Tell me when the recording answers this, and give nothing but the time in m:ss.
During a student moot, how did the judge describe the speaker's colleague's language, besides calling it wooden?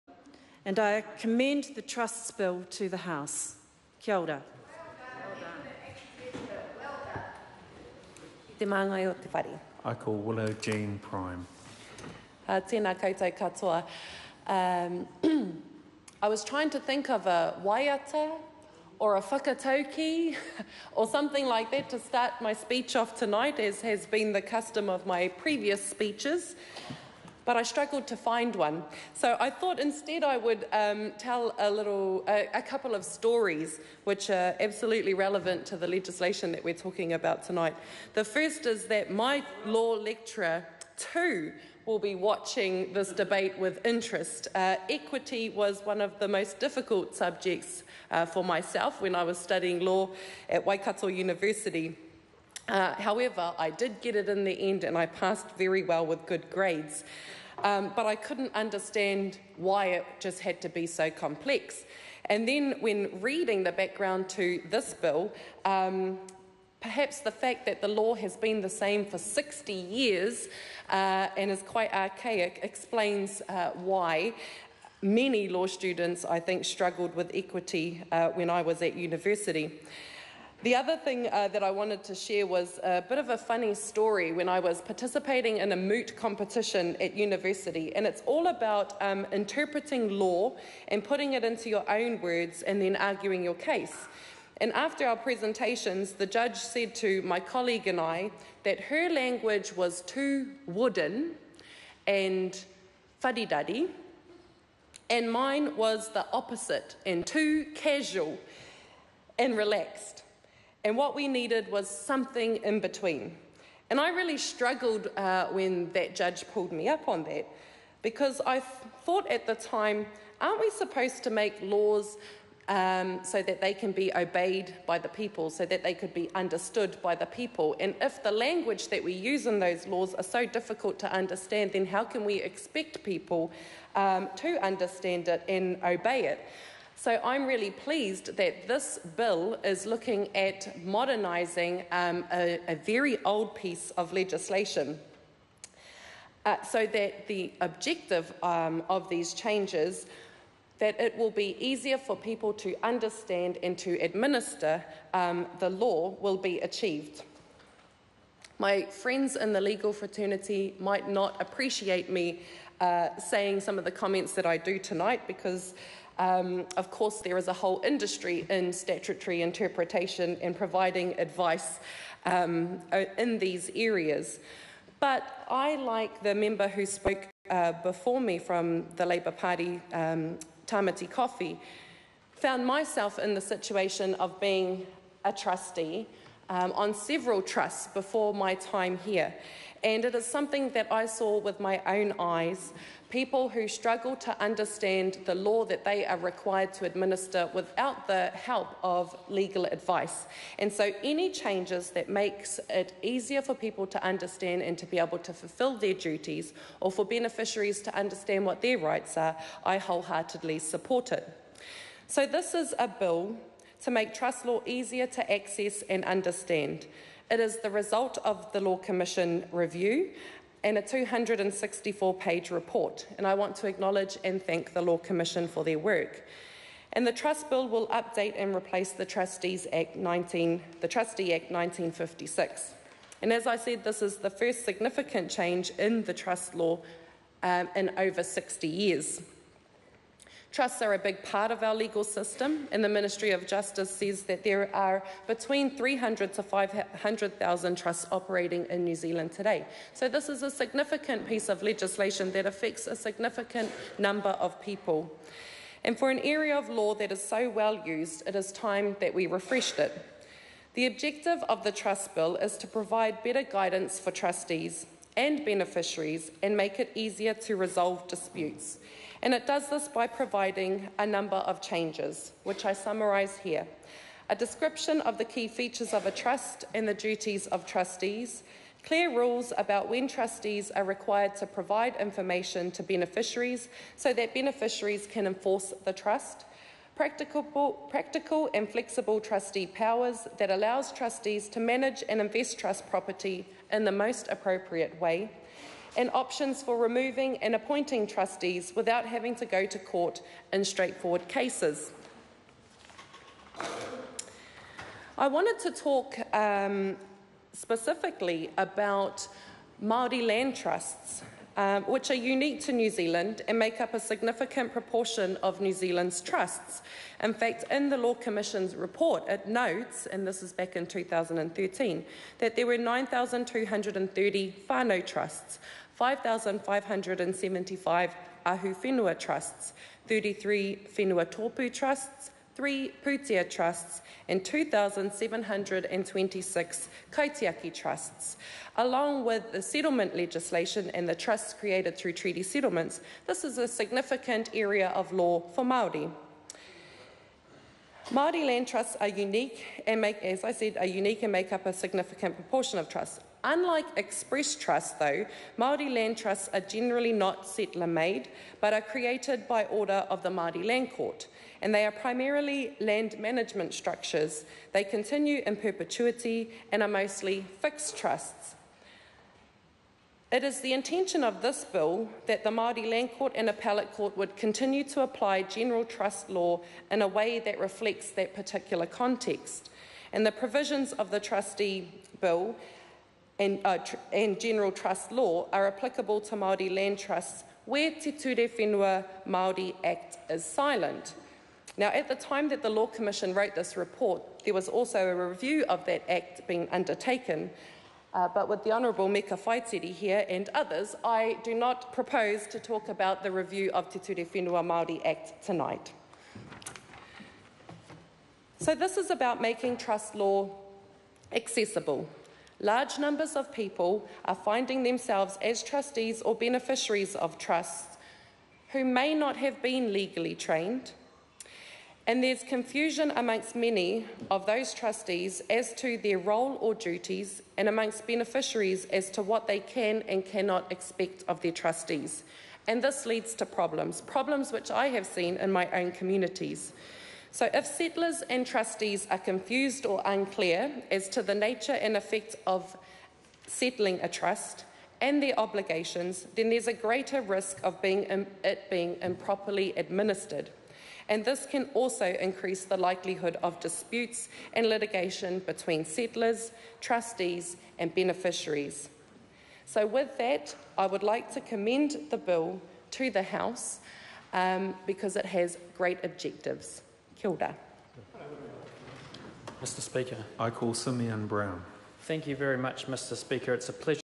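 1:43.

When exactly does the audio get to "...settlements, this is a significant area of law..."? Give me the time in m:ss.
5:42.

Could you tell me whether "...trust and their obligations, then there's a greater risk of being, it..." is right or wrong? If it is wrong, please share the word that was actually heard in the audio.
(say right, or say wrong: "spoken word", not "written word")
right.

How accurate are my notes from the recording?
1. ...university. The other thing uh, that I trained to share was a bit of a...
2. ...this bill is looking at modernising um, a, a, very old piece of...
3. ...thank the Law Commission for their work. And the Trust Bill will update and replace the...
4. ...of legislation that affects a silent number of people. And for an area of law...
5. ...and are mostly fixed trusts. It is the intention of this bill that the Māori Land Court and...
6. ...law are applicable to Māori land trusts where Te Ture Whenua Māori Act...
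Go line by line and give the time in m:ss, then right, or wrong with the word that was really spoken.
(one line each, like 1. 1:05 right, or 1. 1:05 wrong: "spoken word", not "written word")
1. 1:18 wrong: "wanted", not "trained"
2. 2:18 right
3. 3:44 right
4. 4:11 wrong: "significant", not "silent"
5. 6:06 right
6. 6:25 right.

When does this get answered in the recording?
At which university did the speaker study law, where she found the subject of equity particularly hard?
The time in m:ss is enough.
0:50.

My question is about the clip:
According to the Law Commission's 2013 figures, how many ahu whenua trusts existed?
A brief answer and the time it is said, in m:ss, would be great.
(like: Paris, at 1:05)
5,575, at 5:25.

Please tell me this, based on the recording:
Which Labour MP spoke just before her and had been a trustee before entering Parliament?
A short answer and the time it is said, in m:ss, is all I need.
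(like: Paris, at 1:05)
Tamati Coffey, at 3:00.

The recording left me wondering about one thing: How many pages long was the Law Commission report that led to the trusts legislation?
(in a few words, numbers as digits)
264.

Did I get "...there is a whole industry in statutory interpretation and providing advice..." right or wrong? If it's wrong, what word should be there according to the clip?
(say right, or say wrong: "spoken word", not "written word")
right.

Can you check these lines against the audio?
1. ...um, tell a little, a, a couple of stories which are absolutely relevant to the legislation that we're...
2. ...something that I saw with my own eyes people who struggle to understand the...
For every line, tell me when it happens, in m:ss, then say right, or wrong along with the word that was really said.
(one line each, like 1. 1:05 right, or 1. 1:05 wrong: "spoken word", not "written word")
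1. 0:30 right
2. 3:10 right.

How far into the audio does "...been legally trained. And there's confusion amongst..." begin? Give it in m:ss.
6:59.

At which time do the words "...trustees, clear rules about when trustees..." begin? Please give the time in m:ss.
4:37.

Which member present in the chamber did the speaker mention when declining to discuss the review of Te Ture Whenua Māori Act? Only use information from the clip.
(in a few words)
Meka Whaitiri.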